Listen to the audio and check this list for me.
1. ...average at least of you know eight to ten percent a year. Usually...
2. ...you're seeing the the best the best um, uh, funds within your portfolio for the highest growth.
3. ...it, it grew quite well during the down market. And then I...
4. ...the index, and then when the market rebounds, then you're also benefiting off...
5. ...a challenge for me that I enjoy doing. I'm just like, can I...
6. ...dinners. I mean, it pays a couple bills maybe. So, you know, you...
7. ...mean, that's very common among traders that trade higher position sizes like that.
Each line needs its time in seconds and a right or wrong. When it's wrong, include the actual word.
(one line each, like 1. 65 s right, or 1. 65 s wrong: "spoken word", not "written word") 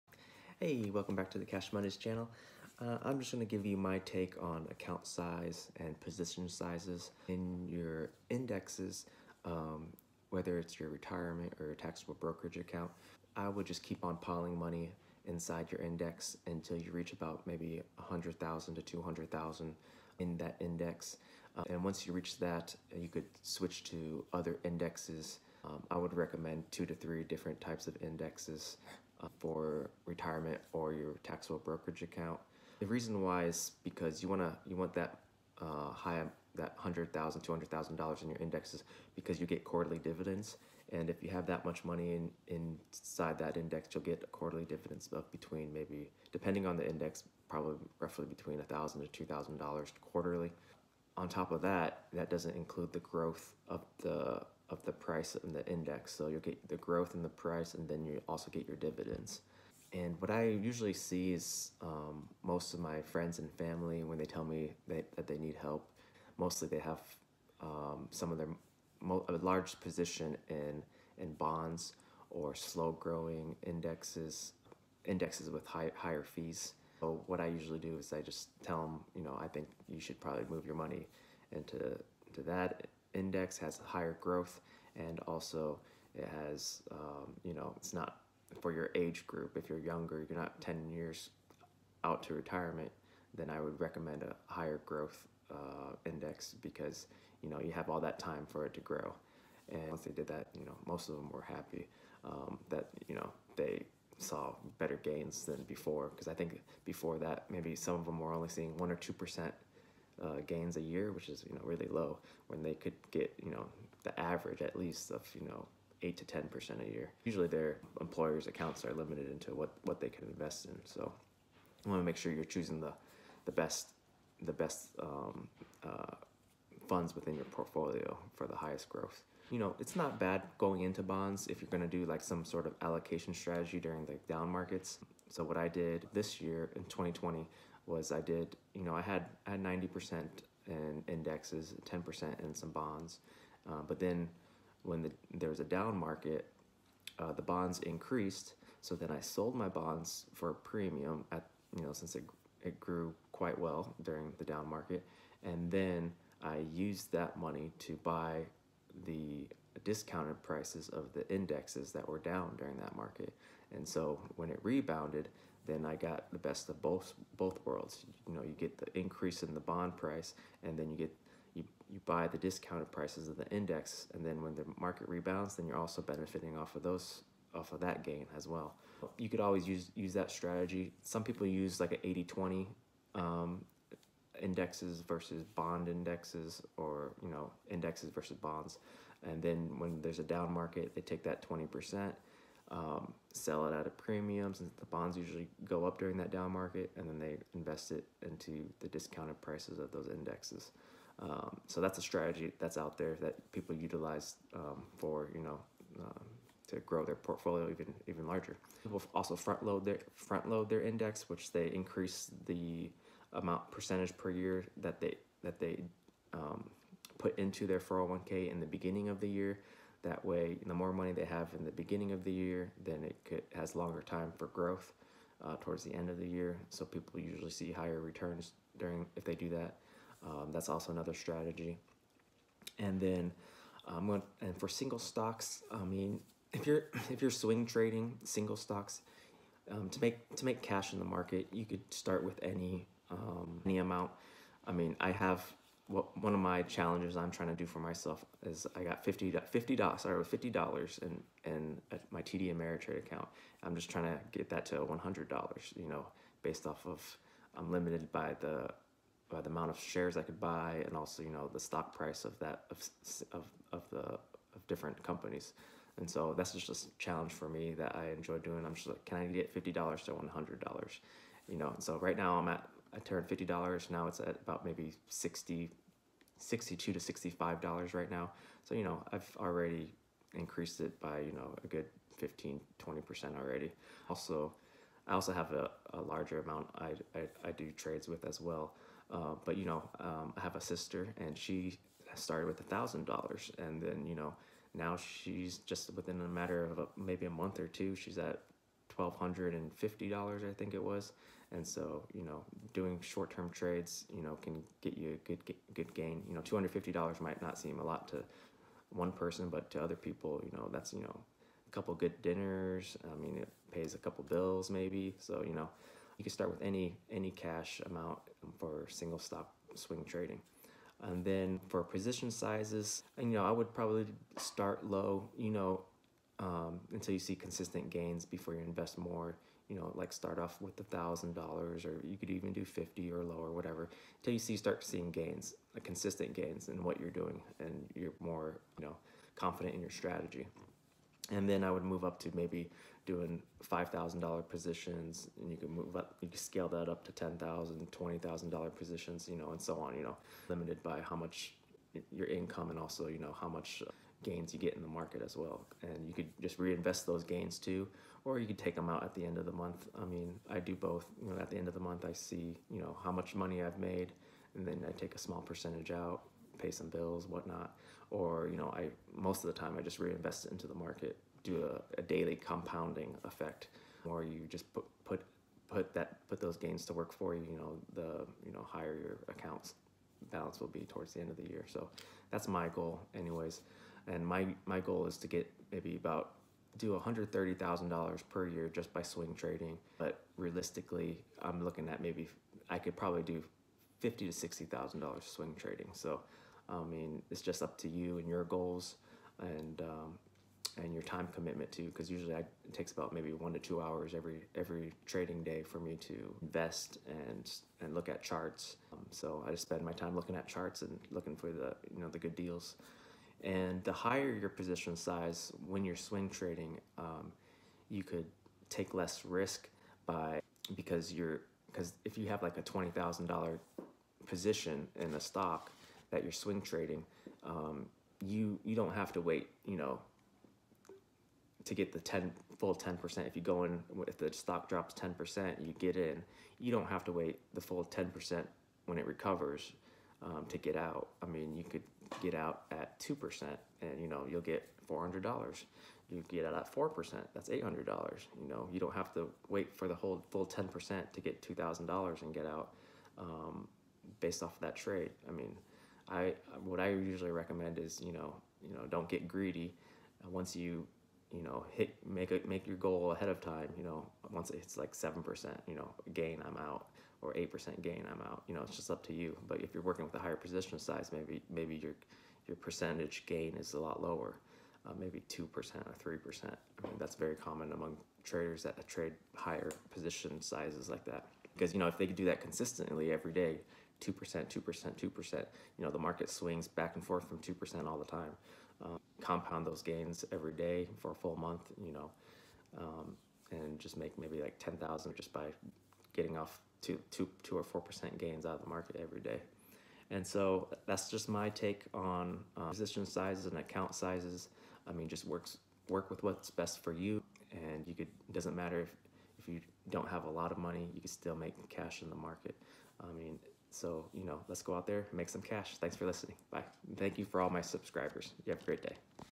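1. 114 s right
2. 122 s wrong: "choosing", not "seeing"
3. 152 s right
4. 173 s right
5. 266 s right
6. 312 s right
7. 476 s right.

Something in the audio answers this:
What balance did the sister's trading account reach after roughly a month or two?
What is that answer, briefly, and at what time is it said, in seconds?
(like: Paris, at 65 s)
$1,250, at 298 s.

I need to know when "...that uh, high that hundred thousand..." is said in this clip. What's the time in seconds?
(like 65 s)
34 s.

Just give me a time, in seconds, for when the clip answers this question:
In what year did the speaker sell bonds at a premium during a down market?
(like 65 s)
136 s.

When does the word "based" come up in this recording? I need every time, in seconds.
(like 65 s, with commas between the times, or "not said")
256 s, 454 s.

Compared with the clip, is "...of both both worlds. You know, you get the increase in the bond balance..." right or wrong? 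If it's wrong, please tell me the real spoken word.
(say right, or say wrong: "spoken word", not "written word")
wrong: "price", not "balance".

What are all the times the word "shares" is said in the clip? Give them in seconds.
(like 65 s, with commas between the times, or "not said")
259 s.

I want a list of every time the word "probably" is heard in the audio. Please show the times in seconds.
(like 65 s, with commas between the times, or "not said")
47 s, 80 s, 323 s, 392 s.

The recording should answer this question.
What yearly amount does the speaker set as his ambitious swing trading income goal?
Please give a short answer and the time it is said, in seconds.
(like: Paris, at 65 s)
$130,000, at 387 s.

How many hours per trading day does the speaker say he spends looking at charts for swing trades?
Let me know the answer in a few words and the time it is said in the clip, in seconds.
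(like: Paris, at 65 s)
1 to 2 hours, at 403 s.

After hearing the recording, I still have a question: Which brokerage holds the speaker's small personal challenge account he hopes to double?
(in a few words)
TD Ameritrade.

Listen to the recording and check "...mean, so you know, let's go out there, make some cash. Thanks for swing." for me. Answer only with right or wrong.
wrong.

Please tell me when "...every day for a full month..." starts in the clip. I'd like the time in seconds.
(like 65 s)
490 s.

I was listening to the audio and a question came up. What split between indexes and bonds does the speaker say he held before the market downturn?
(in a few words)
90% indexes, 10% bonds.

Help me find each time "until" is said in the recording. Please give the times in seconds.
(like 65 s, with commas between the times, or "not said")
16 s, 326 s, 334 s.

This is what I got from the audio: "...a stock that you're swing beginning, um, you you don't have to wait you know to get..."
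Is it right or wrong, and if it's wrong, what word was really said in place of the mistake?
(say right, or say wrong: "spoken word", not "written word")
wrong: "trading", not "beginning".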